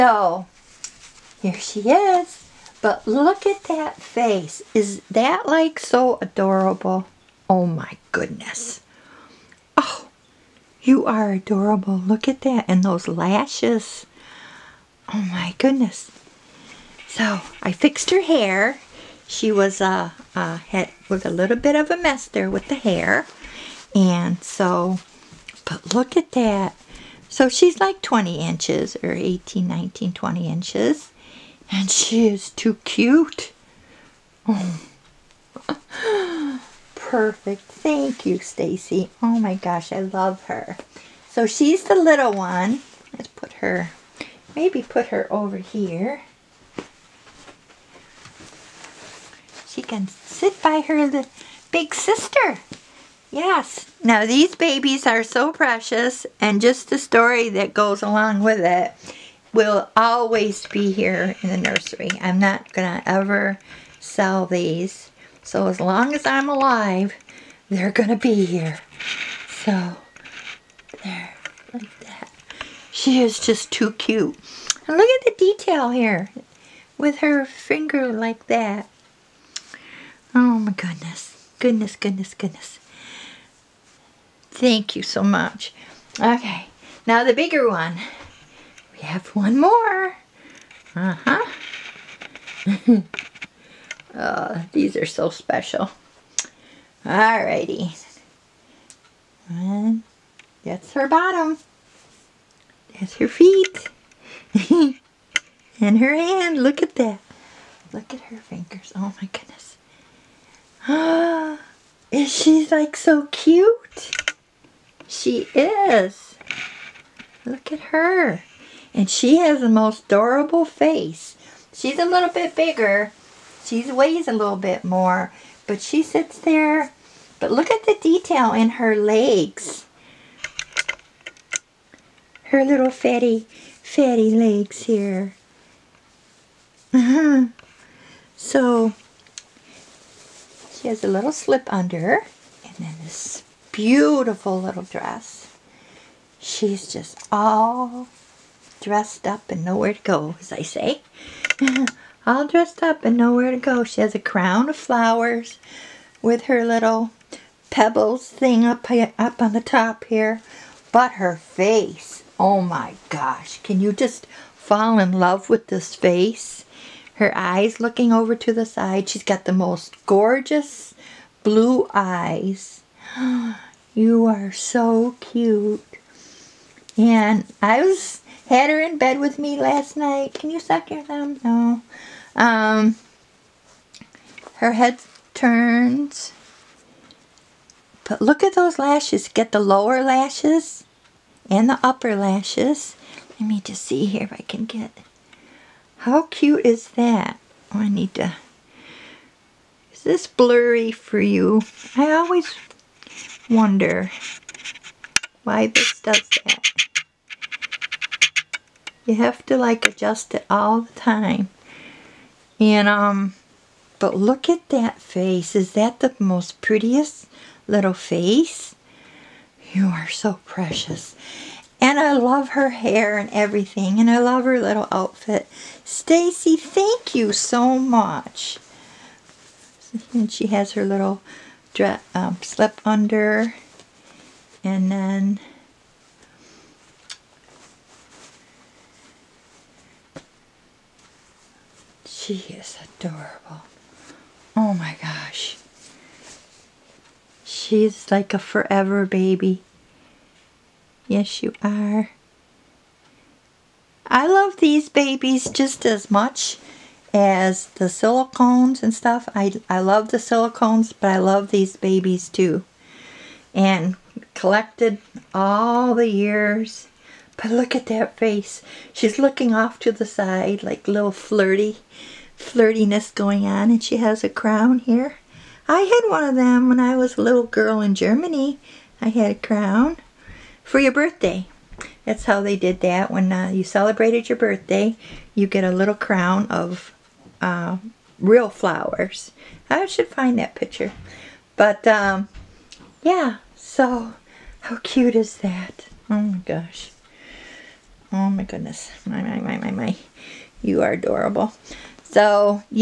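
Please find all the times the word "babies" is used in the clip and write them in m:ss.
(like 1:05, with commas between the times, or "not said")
0:54, 4:14, 4:21.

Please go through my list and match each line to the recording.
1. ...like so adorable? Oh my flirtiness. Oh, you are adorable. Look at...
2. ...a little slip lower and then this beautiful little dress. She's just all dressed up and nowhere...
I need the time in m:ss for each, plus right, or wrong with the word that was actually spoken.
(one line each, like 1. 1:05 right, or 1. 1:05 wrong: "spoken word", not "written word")
1. 0:05 wrong: "goodness", not "flirtiness"
2. 2:21 wrong: "under", not "lower".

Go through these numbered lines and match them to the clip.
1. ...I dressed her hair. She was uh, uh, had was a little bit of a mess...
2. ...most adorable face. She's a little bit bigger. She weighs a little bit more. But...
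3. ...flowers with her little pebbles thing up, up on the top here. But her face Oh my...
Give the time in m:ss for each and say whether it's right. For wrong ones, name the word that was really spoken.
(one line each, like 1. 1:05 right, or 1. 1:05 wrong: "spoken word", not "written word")
1. 0:17 wrong: "fixed", not "dressed"
2. 1:59 right
3. 2:34 right.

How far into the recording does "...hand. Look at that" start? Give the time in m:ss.
1:46.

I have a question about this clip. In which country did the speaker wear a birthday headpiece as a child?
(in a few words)
Germany.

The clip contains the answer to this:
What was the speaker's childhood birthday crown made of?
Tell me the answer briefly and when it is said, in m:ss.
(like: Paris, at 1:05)
real flowers, at 4:48.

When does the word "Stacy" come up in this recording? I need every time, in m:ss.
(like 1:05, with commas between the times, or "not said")
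0:38, 3:45.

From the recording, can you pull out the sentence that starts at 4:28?
She's looking off to the side like little flirty, flirtiness going on.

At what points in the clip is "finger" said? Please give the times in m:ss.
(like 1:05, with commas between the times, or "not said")
1:17, 1:48.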